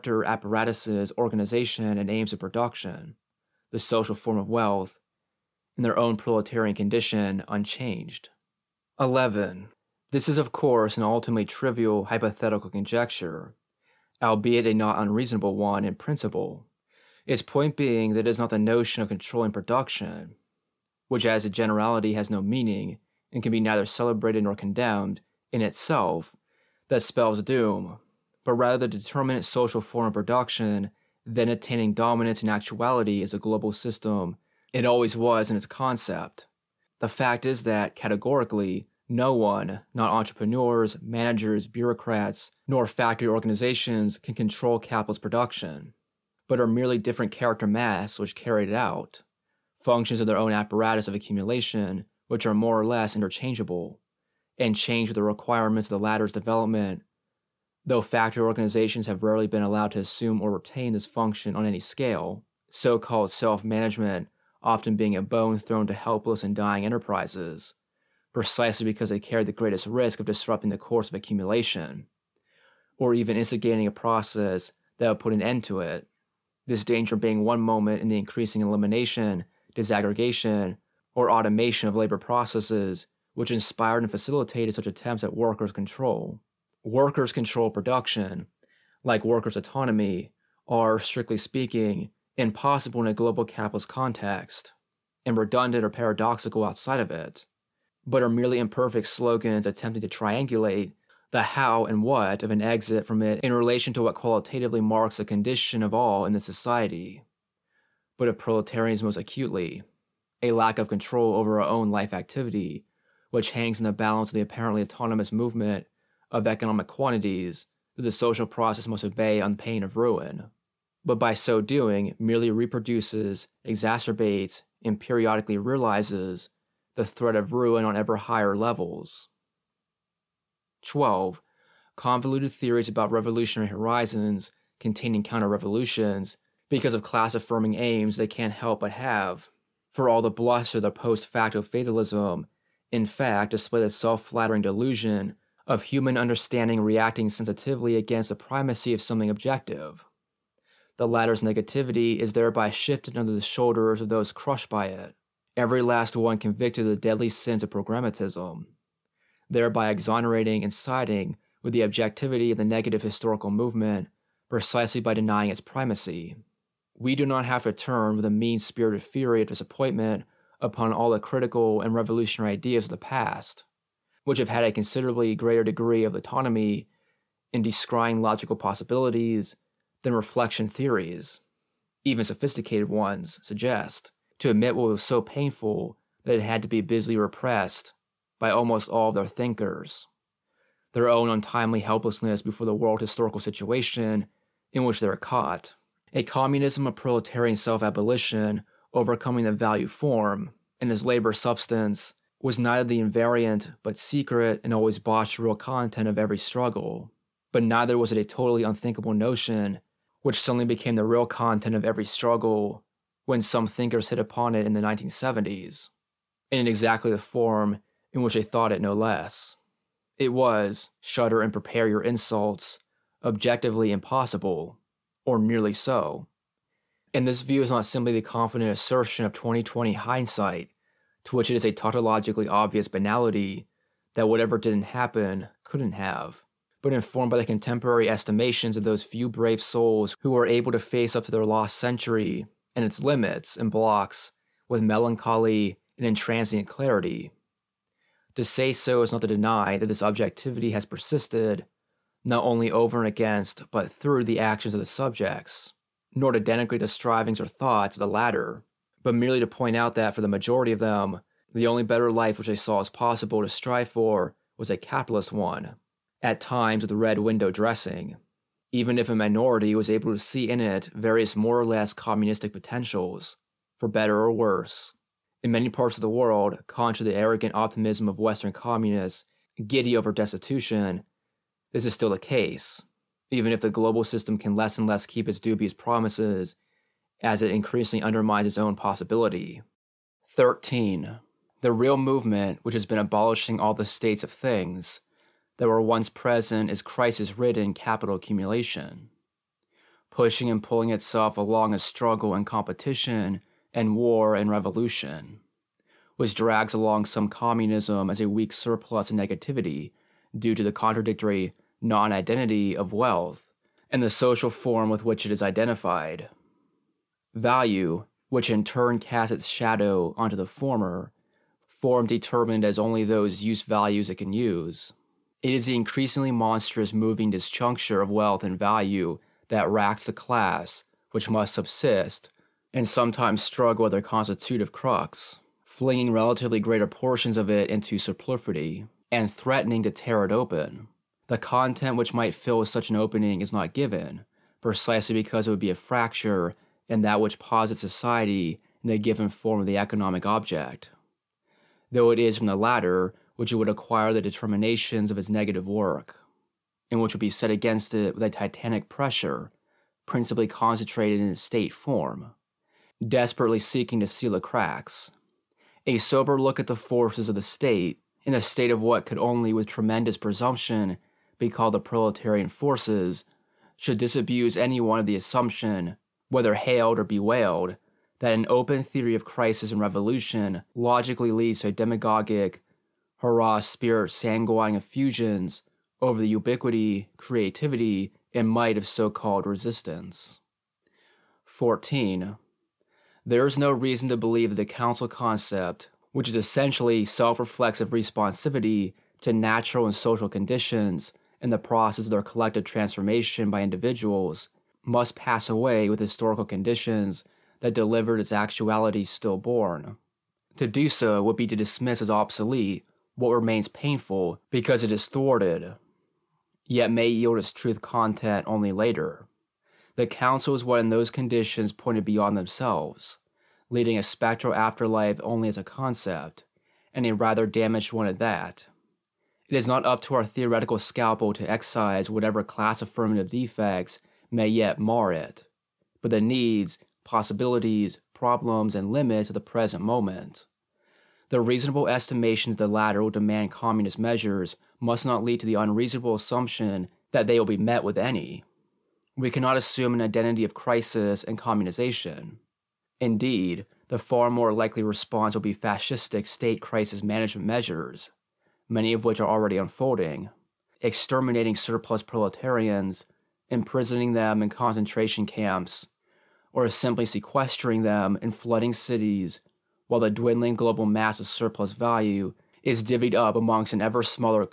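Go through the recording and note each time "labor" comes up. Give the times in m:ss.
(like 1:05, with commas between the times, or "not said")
1:21, 3:21.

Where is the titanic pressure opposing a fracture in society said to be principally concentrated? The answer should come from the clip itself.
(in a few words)
Its state form.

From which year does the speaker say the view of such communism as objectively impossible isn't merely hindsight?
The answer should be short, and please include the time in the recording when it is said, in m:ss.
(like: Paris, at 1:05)
2020, at 3:49.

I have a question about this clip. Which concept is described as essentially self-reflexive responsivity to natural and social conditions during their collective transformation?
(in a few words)
The council concept.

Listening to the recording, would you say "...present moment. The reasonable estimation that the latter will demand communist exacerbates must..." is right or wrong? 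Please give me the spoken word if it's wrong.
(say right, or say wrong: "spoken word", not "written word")
wrong: "measures", not "exacerbates".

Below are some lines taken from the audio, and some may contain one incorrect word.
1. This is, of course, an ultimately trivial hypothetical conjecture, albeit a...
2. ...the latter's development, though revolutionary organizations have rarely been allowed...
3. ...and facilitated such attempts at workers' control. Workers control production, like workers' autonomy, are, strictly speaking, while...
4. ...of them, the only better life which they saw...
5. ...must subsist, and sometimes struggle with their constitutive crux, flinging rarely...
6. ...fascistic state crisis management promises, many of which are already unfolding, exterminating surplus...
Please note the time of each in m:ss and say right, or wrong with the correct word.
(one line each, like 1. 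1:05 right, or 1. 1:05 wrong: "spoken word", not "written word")
1. 0:10 right
2. 0:55 wrong: "factory", not "revolutionary"
3. 1:24 wrong: "impossible", not "while"
4. 4:20 right
5. 5:31 wrong: "relatively", not "rarely"
6. 7:35 wrong: "measures", not "promises".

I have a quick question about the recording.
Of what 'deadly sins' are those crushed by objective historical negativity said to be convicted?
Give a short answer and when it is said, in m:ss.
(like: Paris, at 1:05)
Programmatism, at 2:37.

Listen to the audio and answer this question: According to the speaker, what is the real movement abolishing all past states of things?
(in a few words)
Crisis ridden capital accumulation.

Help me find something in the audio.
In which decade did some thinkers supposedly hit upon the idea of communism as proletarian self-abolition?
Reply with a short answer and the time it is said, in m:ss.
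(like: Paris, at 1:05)
1970s, at 3:34.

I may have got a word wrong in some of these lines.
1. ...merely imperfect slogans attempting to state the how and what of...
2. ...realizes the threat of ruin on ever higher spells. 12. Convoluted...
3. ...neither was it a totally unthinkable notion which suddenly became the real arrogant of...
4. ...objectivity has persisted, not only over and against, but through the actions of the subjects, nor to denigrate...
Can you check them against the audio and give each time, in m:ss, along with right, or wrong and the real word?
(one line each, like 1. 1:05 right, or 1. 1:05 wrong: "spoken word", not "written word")
1. 1:38 wrong: "triangulate", not "state"
2. 2:05 wrong: "levels", not "spells"
3. 3:27 wrong: "content", not "arrogant"
4. 4:10 right.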